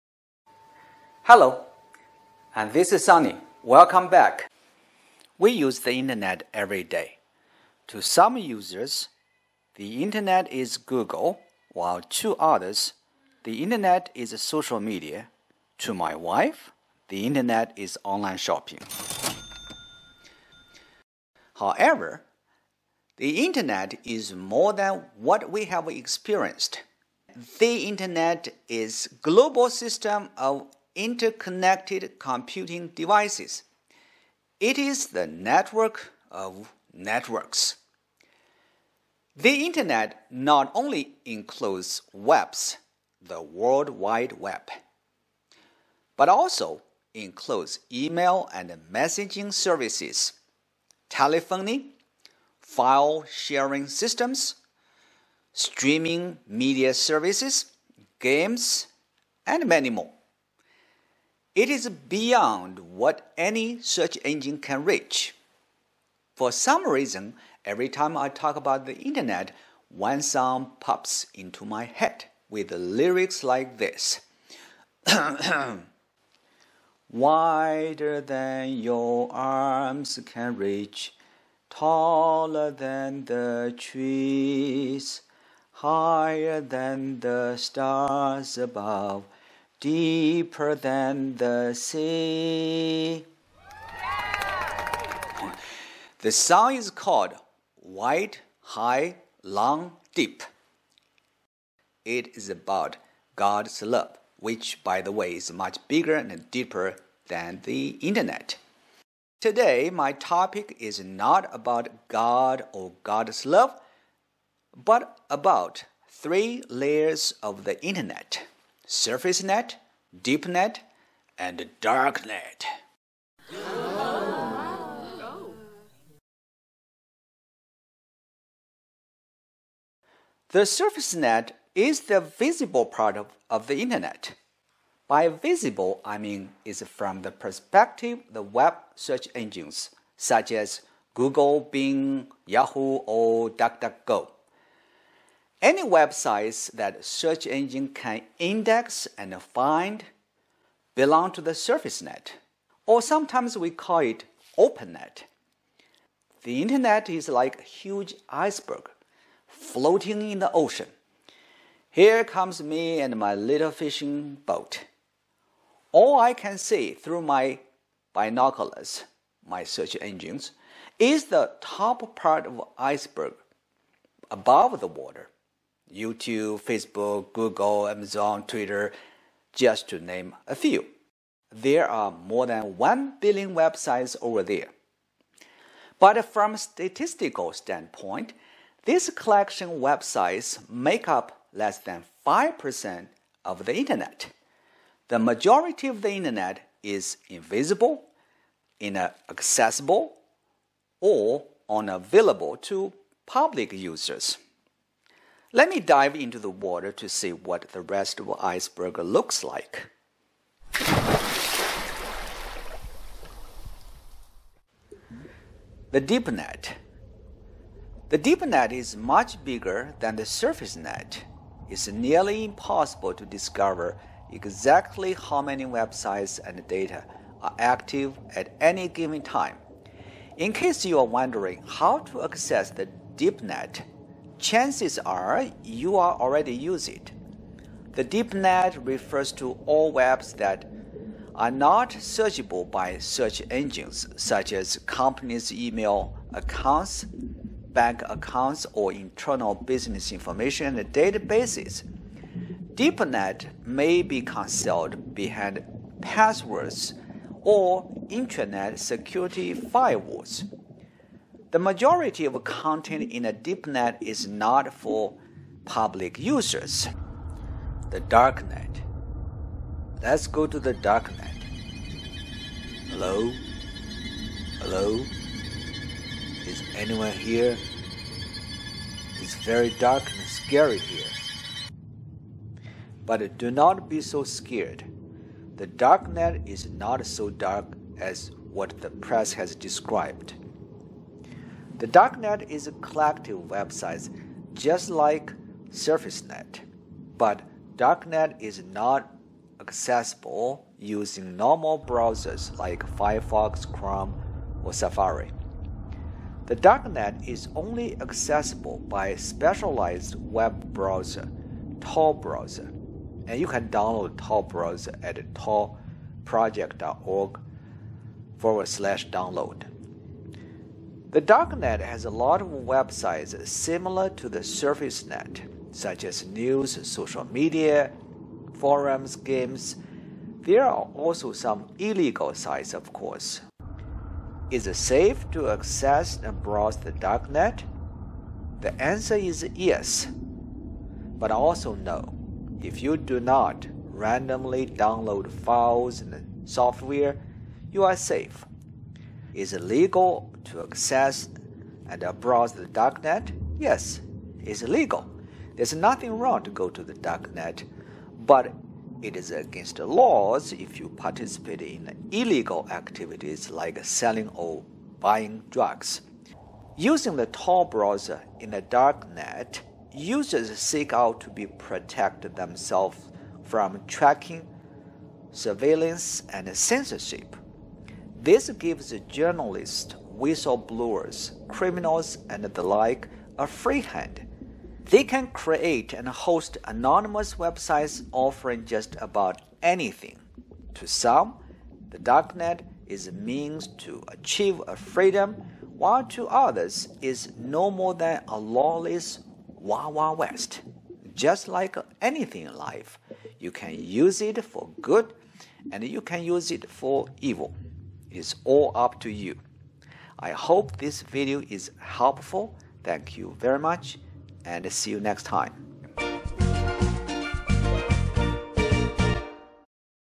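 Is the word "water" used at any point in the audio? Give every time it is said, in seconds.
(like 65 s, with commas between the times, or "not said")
174 s, 206 s.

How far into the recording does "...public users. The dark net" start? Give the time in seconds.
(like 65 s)
265 s.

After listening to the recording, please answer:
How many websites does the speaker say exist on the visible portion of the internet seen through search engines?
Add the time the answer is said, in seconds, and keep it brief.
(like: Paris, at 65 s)
more than 1 billion, at 182 s.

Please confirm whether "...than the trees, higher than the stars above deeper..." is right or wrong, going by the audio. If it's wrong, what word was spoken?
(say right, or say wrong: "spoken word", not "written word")
right.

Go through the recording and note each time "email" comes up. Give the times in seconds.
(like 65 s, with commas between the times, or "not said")
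47 s, 245 s.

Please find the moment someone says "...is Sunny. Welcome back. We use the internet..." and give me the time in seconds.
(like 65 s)
2 s.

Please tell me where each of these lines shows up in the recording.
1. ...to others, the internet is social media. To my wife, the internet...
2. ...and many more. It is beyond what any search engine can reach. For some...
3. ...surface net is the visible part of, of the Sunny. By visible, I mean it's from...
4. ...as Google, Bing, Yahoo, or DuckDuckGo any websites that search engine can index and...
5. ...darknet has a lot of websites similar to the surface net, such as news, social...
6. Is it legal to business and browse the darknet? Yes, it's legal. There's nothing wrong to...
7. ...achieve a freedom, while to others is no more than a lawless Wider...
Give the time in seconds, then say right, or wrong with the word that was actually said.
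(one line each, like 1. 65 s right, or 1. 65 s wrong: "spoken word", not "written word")
1. 12 s right
2. 59 s right
3. 130 s wrong: "Internet", not "Sunny"
4. 140 s right
5. 321 s right
6. 349 s wrong: "access", not "business"
7. 394 s wrong: "Wild", not "Wider".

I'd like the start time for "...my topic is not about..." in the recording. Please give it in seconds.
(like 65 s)
109 s.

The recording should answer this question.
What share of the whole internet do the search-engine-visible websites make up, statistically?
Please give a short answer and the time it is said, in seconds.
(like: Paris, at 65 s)
less than 5%, at 191 s.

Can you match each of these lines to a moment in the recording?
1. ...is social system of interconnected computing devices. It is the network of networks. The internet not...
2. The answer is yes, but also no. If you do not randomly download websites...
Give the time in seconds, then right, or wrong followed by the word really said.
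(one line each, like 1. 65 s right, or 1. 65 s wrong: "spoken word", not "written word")
1. 28 s wrong: "global", not "social"
2. 338 s wrong: "files", not "websites".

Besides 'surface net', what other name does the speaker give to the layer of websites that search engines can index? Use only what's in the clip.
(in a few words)
open net.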